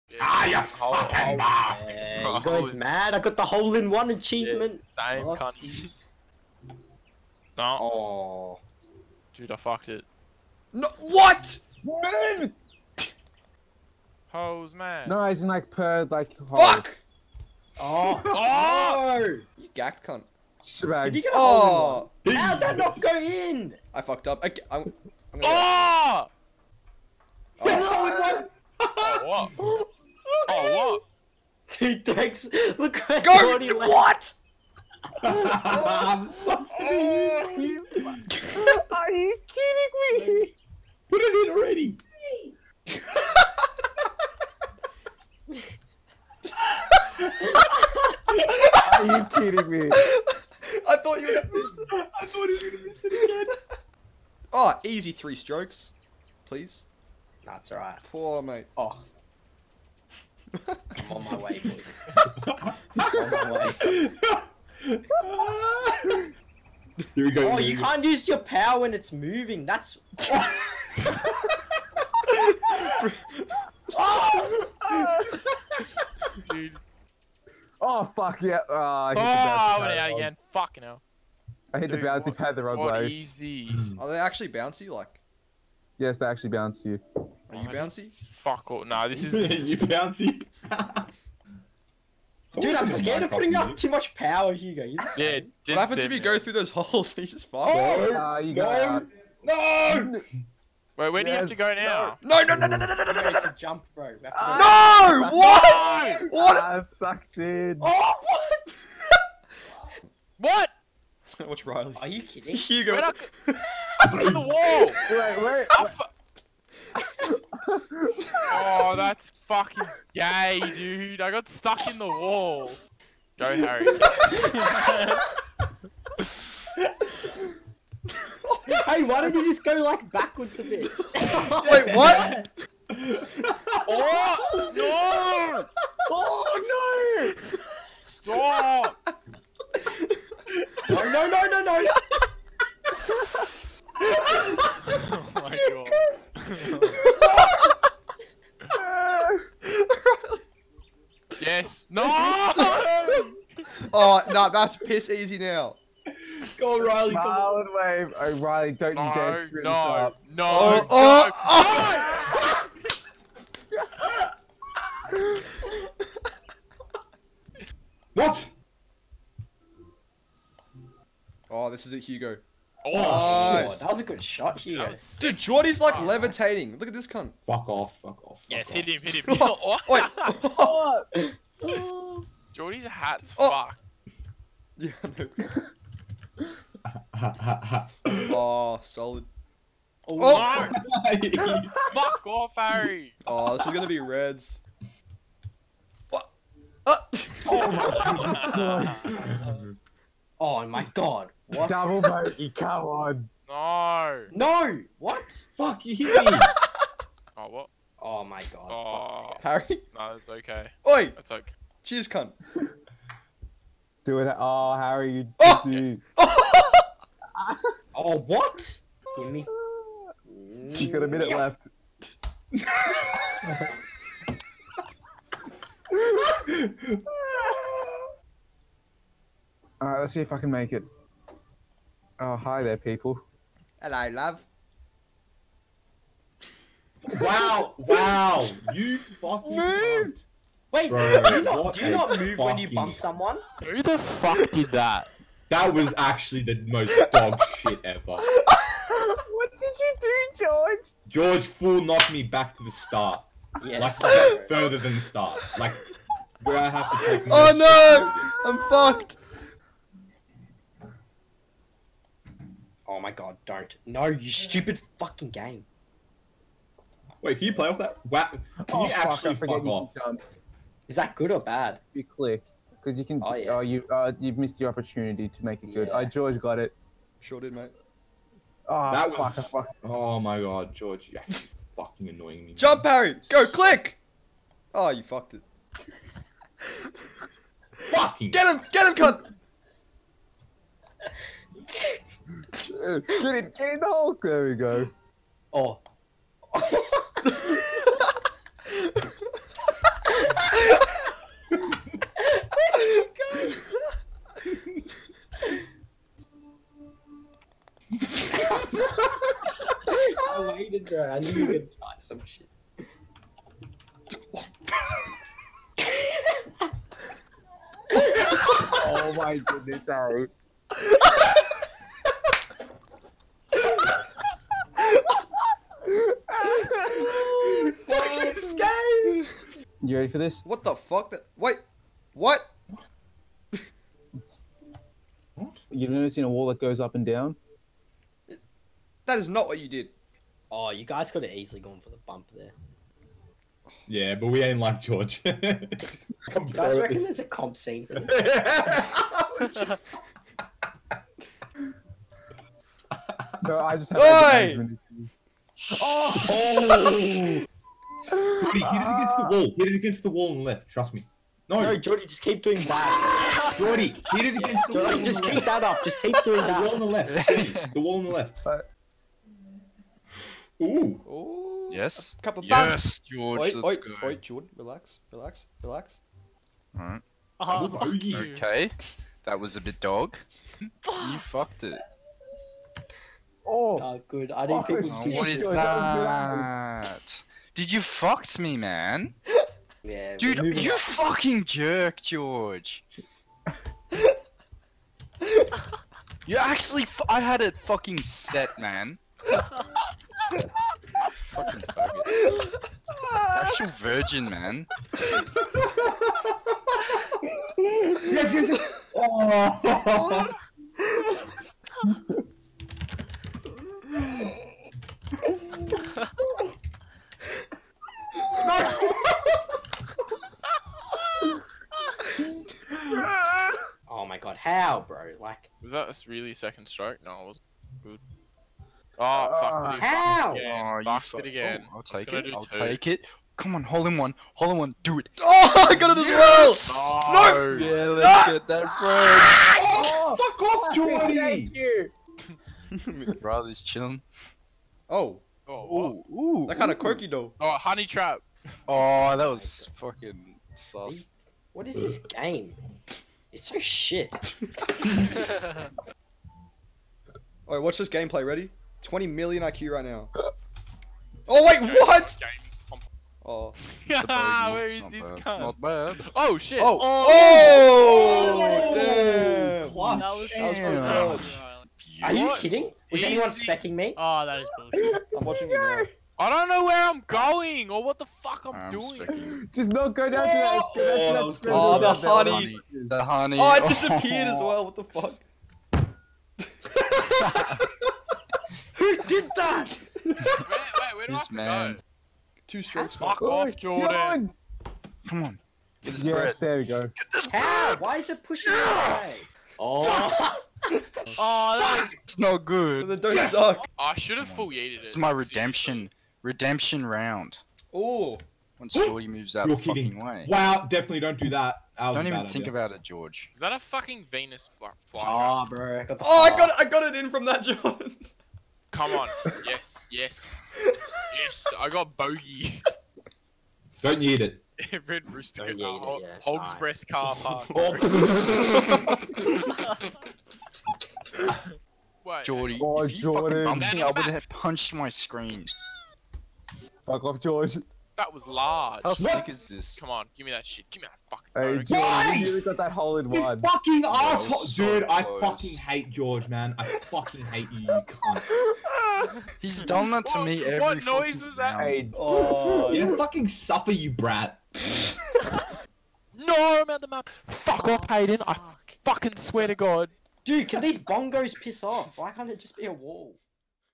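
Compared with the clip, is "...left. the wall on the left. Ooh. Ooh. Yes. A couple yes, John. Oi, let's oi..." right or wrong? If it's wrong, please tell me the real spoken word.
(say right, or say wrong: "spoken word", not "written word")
wrong: "George", not "John".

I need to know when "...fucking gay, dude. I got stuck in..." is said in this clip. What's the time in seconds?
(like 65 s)
119 s.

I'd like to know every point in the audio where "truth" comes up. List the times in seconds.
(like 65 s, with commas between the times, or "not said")
not said.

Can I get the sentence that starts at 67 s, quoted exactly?
Oh, you can't use your power when it's moving.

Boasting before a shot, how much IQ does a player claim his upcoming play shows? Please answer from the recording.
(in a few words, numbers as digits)
20 million.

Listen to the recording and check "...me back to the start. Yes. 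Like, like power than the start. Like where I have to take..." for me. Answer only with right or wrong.
wrong.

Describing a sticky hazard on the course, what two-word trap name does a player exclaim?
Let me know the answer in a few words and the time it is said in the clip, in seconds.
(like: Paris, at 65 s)
honey trap, at 447 s.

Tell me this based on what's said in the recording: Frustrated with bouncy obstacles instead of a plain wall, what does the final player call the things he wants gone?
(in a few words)
bongos.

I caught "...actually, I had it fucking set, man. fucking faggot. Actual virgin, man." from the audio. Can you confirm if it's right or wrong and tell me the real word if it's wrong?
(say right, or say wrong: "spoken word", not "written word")
right.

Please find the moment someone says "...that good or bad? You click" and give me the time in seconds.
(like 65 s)
270 s.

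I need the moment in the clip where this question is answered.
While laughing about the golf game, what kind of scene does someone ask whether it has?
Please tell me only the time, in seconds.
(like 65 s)
347 s.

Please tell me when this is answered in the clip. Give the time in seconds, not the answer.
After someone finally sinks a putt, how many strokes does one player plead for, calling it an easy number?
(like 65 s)
55 s.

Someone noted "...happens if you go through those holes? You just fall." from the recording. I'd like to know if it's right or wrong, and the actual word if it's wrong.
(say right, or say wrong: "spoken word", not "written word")
right.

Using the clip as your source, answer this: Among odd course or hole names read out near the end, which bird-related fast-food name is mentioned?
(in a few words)
Red Rooster.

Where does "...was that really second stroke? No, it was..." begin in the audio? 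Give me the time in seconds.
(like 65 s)
425 s.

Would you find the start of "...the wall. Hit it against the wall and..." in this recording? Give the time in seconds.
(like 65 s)
359 s.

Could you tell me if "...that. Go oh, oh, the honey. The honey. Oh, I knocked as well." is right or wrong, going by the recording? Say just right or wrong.
wrong.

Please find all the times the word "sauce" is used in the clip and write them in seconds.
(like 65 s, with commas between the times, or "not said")
450 s.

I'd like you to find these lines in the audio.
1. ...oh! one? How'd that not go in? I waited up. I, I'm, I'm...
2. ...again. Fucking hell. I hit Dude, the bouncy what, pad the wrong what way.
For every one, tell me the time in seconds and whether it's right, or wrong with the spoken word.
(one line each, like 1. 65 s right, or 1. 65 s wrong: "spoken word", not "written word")
1. 22 s wrong: "fucked", not "waited"
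2. 80 s right.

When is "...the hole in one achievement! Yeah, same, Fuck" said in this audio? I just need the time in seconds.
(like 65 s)
3 s.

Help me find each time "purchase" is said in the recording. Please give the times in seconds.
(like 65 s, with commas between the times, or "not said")
not said.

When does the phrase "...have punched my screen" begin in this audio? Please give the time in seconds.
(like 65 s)
534 s.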